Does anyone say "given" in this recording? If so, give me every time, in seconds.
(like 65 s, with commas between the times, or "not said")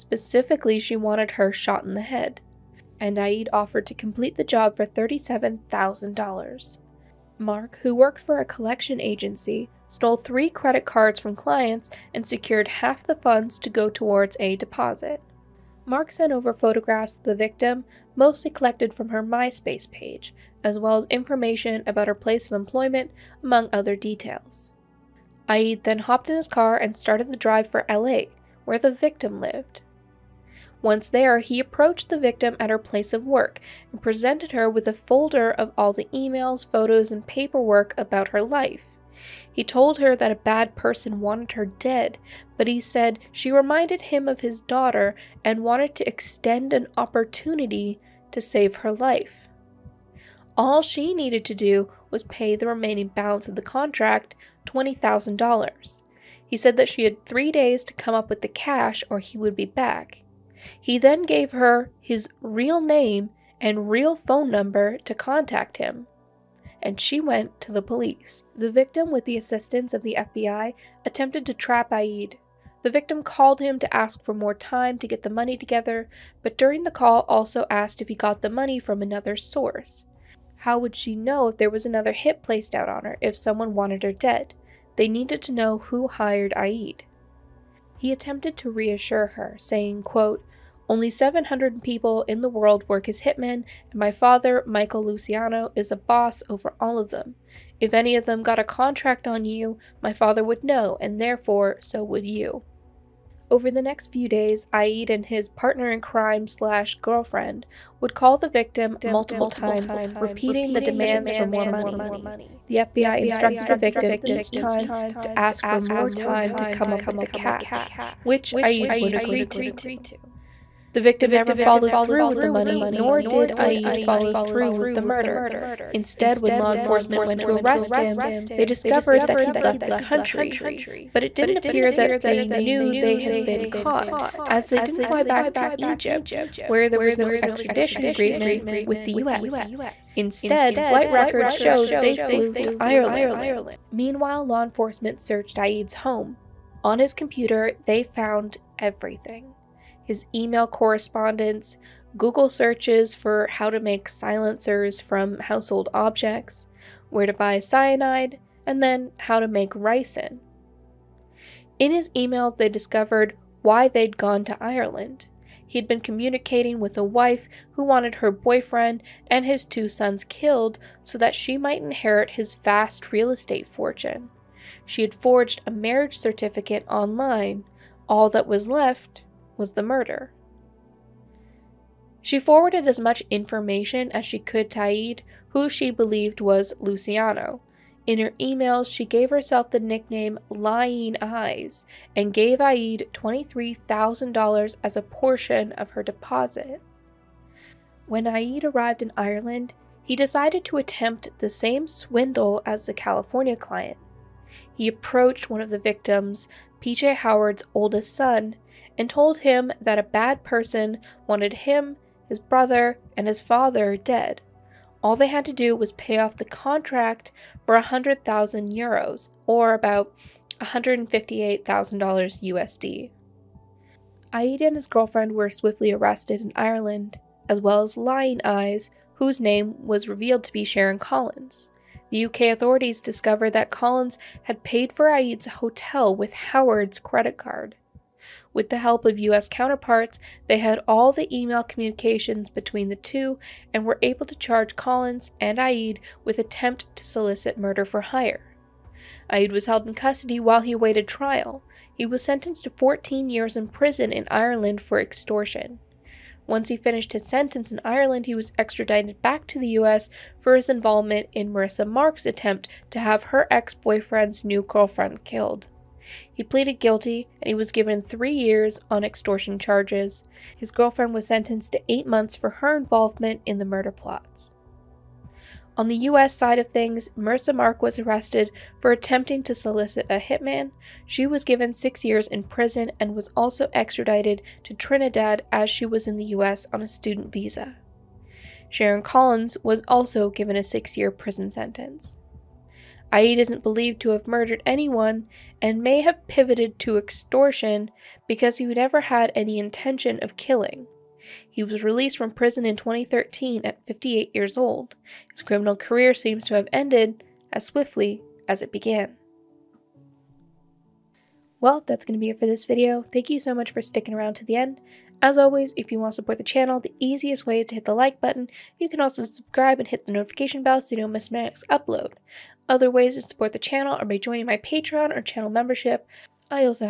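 267 s, 281 s, 290 s.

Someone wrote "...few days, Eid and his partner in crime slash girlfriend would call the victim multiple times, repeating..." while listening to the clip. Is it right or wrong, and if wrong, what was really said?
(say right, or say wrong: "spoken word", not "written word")
right.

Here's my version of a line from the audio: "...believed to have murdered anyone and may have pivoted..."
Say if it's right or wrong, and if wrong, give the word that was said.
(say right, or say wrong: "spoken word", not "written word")
right.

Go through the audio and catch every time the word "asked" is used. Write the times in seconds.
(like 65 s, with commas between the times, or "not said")
77 s.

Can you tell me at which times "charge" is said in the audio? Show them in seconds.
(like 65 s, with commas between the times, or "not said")
244 s, 269 s.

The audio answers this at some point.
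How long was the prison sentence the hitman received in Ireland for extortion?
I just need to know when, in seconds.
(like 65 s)
252 s.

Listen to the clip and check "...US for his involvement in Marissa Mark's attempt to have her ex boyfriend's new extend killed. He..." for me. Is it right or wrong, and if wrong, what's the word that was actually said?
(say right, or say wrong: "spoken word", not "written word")
wrong: "girlfriend", not "extend".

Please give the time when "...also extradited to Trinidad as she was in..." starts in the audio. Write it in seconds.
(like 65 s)
283 s.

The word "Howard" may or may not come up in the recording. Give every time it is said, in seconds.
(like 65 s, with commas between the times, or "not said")
207 s, 236 s.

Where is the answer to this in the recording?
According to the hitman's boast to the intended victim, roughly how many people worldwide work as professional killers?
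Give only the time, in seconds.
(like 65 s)
91 s.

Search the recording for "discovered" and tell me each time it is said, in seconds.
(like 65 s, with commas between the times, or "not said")
128 s, 162 s, 233 s.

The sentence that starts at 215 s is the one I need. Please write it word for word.
All they had to do was pay off the contract for 100,000 euros, or about $158,000 USD.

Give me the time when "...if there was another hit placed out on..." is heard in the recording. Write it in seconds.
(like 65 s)
81 s.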